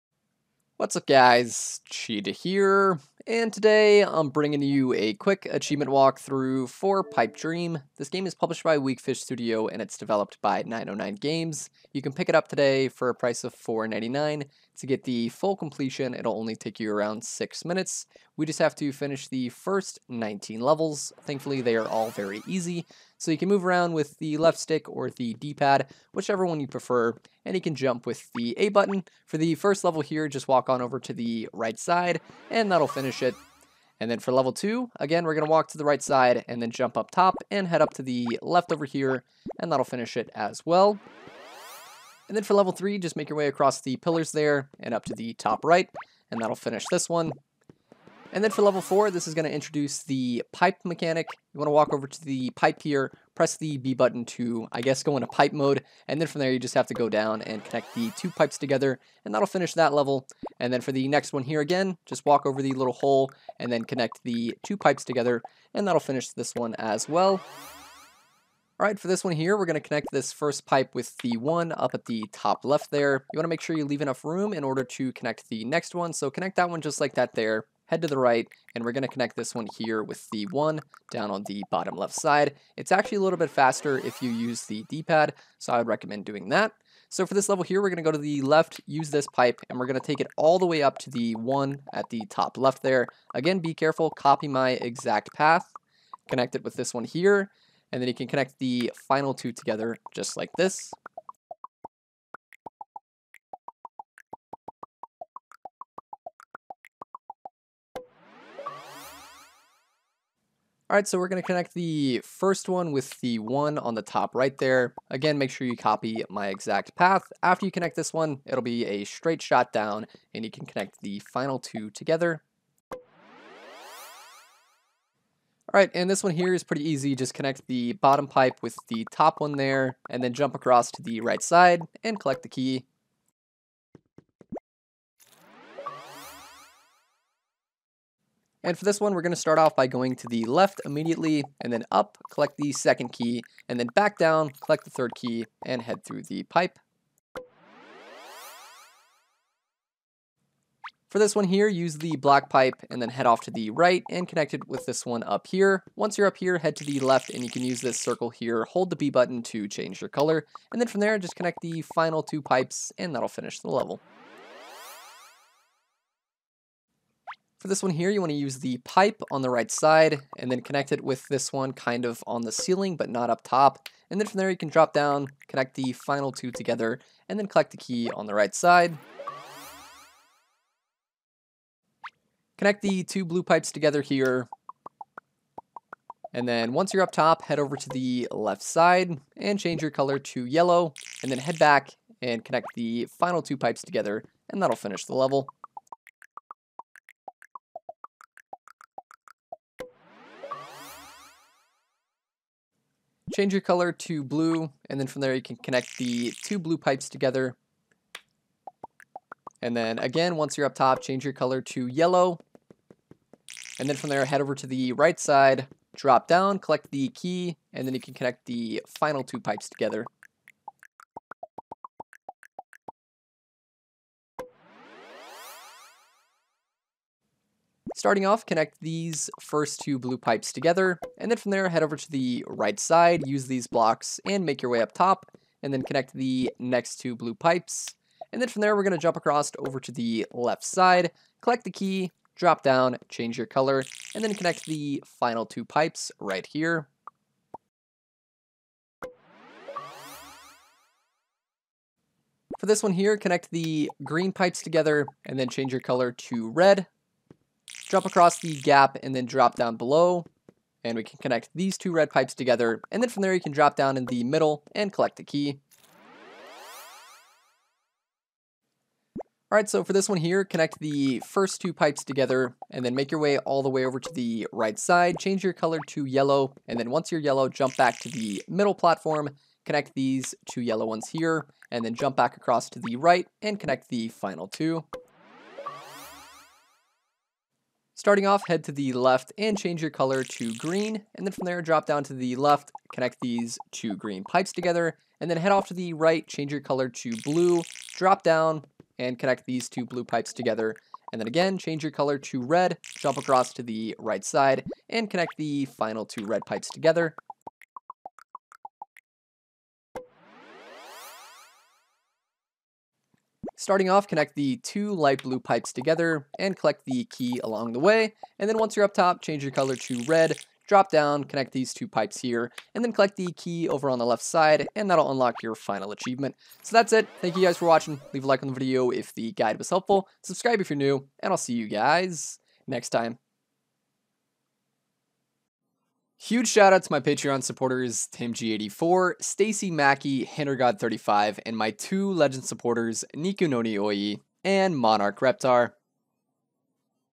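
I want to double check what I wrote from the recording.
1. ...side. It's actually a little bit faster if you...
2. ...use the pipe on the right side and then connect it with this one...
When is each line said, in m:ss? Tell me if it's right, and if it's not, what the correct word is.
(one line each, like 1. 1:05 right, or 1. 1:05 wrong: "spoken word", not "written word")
1. 1:22 right
2. 2:48 right.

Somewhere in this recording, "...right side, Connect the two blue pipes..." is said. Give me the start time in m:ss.
2:58.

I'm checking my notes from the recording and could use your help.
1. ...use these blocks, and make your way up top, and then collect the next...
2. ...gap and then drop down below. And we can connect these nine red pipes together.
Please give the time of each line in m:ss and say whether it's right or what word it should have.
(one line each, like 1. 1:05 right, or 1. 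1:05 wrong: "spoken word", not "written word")
1. 3:53 wrong: "connect", not "collect"
2. 4:18 wrong: "two", not "nine".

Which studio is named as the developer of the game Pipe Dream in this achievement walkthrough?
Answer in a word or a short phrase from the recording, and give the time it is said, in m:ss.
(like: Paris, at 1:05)
909 Games, at 0:10.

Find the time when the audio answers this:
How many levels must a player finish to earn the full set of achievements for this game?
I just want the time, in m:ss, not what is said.
0:20.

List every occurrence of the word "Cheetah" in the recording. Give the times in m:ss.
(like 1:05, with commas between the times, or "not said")
0:01.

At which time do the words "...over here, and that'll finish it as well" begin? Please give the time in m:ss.
0:38.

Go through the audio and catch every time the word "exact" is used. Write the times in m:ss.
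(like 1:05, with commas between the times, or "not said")
1:34, 1:56.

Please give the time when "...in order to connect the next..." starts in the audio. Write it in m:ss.
1:14.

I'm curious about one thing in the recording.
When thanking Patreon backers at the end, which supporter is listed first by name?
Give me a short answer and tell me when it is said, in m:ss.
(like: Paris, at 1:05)
TimG84, at 5:38.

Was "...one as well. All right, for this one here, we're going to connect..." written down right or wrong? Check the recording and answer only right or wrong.
right.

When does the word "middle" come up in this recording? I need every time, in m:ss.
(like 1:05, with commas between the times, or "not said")
4:24, 4:38.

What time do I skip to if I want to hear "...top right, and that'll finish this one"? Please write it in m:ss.
0:45.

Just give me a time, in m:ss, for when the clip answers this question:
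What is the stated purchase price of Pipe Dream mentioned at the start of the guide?
0:13.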